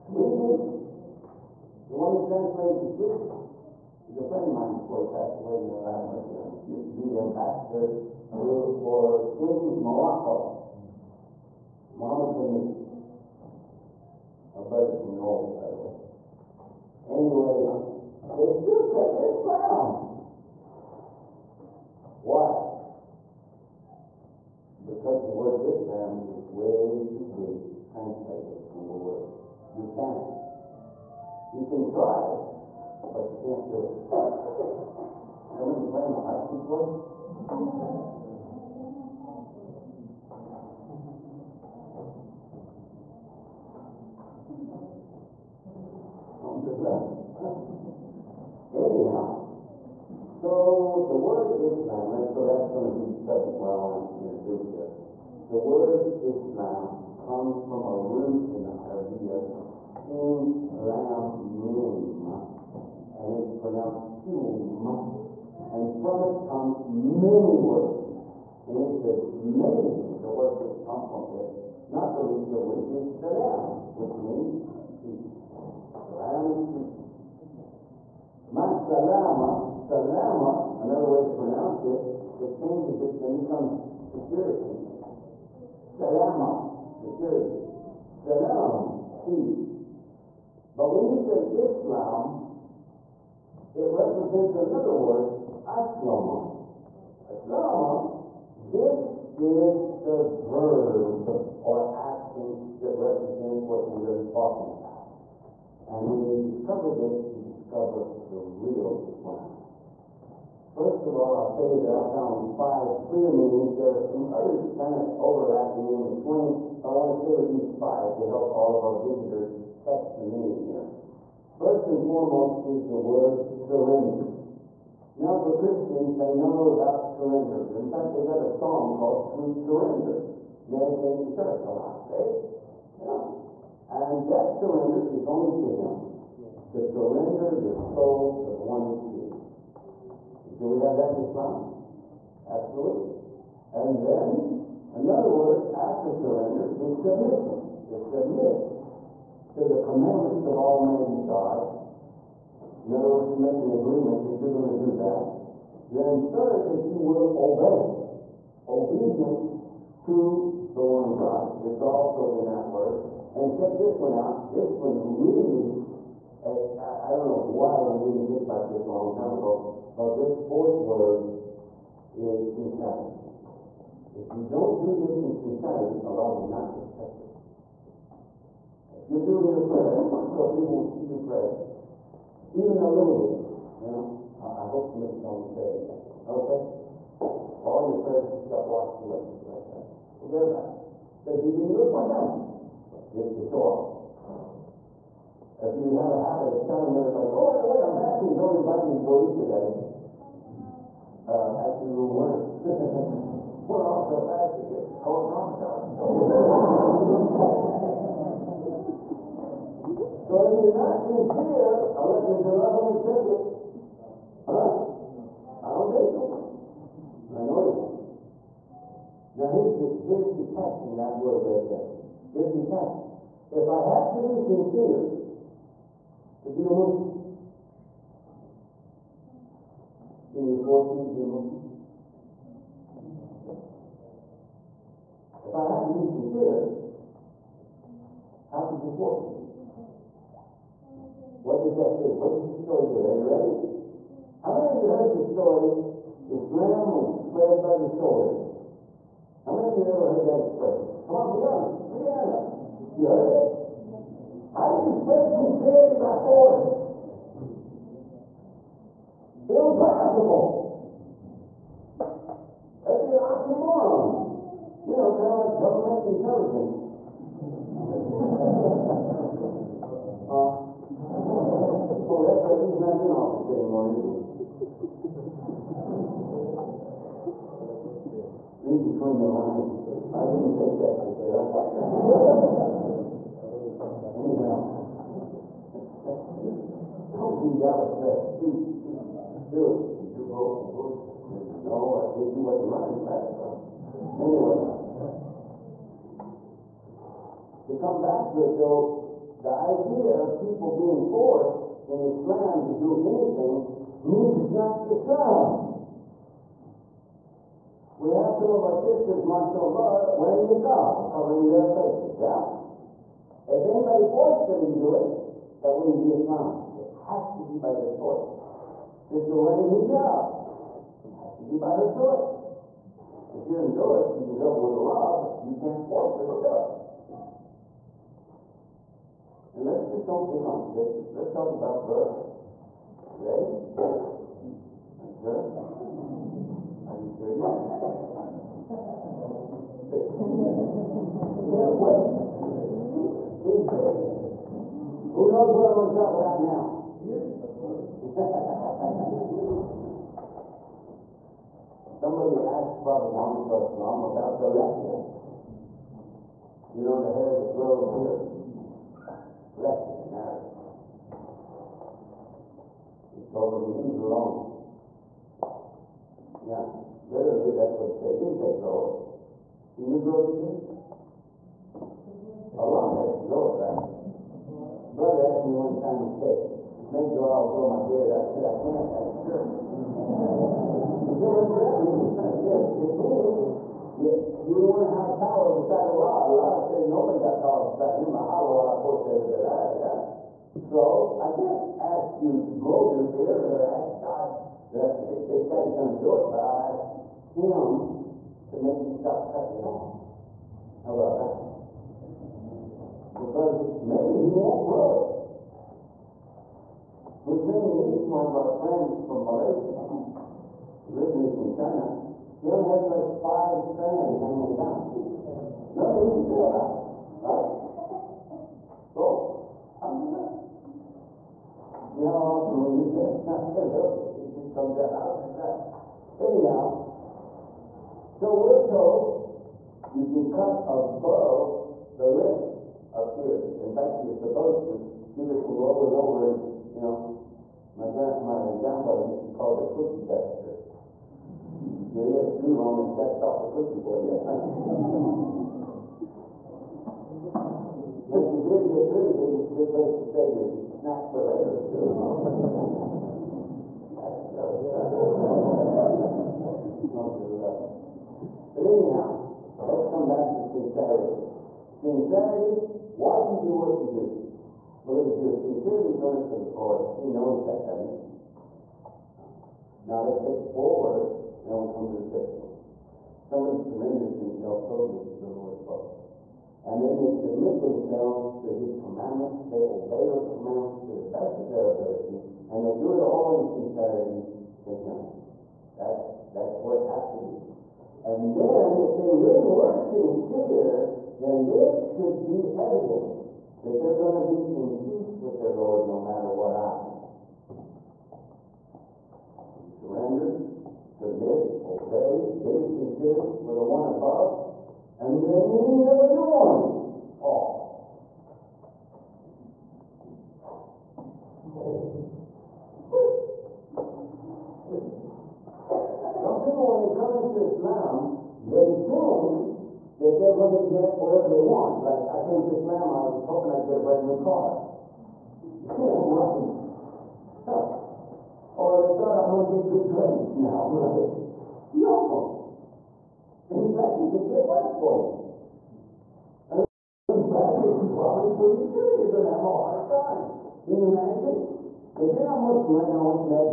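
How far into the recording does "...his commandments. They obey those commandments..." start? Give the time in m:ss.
7:58.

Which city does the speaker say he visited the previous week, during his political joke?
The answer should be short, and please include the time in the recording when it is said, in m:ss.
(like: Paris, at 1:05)
Dallas, at 4:47.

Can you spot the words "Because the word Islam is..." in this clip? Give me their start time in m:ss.
0:24.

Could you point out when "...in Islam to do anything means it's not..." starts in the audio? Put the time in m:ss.
5:01.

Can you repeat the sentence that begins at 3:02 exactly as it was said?
Even a little bit, you know.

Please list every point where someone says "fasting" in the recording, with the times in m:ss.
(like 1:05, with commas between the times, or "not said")
3:17, 3:24.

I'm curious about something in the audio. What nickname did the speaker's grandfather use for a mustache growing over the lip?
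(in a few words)
cookie duster.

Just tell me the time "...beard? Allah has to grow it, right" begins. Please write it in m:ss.
6:10.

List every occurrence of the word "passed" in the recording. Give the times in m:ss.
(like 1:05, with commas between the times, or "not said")
0:05.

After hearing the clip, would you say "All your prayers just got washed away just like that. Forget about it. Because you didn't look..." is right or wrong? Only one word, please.
right.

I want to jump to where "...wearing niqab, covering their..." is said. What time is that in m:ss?
5:10.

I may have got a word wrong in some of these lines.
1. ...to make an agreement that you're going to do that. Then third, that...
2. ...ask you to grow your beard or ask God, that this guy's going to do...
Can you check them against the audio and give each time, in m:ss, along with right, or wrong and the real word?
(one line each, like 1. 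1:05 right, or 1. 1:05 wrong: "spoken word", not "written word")
1. 2:33 right
2. 6:31 right.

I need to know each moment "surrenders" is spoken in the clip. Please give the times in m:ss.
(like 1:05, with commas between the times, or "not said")
7:53, 8:19.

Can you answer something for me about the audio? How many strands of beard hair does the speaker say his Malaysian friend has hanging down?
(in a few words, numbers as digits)
5.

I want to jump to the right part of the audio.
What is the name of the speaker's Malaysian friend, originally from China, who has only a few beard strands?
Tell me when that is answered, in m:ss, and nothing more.
6:47.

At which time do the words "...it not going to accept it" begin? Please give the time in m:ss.
3:32.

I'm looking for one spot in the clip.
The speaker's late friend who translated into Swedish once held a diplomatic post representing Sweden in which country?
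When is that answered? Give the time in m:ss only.
0:09.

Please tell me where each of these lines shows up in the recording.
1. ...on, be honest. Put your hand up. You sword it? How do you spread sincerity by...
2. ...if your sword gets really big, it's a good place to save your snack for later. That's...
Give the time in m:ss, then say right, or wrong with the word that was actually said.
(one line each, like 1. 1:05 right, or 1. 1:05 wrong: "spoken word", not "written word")
1. 4:11 wrong: "heard", not "sword"
2. 7:24 wrong: "beard", not "sword".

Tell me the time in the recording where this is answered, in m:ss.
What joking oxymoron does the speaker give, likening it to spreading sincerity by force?
4:25.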